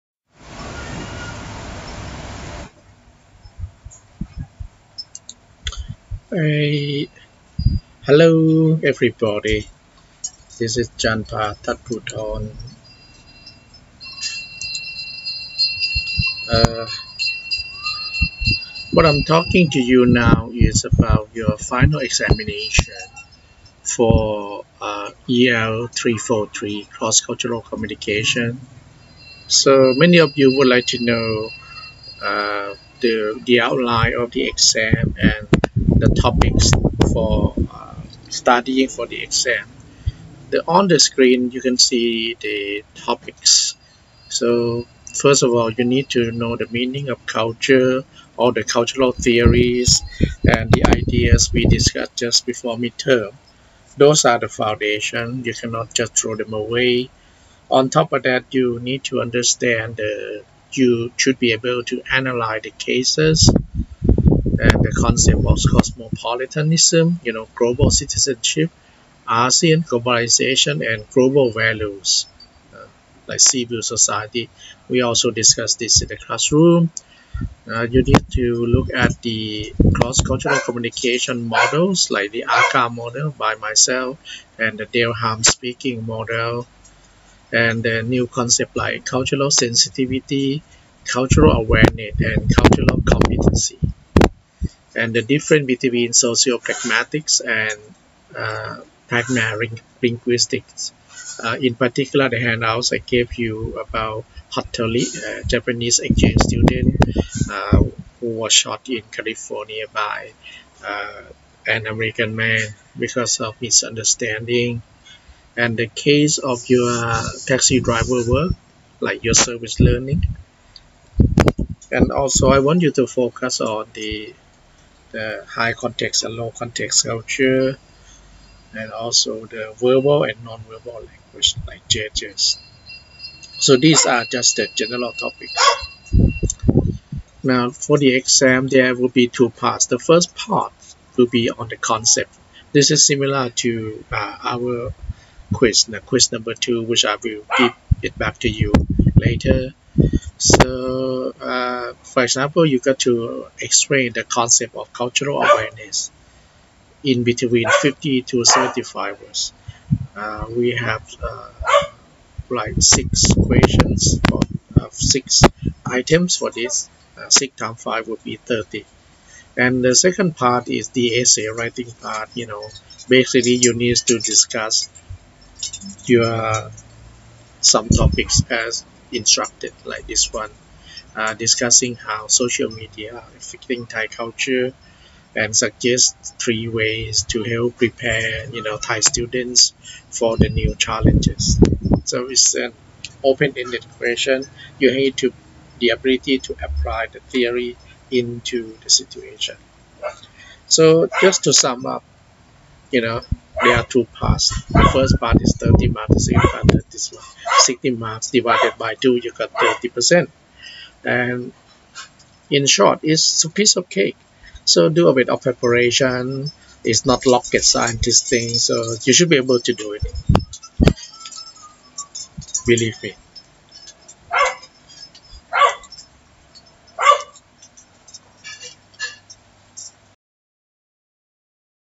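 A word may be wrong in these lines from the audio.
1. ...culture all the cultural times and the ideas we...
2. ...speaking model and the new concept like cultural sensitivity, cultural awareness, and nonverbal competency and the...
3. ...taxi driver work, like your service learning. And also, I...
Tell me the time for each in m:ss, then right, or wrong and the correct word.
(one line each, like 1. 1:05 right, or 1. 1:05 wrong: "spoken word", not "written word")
1. 0:47 wrong: "theories", not "times"
2. 1:25 wrong: "cultural", not "nonverbal"
3. 1:57 right.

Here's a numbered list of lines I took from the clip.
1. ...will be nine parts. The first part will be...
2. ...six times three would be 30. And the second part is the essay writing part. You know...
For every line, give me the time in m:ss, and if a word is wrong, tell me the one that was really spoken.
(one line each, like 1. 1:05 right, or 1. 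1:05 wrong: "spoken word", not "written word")
1. 2:18 wrong: "two", not "nine"
2. 2:47 wrong: "five", not "three".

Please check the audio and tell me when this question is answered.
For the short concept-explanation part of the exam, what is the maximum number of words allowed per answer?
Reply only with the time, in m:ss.
2:38.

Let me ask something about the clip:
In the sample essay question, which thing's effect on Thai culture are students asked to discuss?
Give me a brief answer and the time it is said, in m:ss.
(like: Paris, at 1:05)
social media, at 3:02.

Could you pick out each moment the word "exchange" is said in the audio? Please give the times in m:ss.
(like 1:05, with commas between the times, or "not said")
1:45.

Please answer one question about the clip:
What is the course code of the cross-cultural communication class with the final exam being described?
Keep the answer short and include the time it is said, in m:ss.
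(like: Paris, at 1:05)
EL 343, at 0:25.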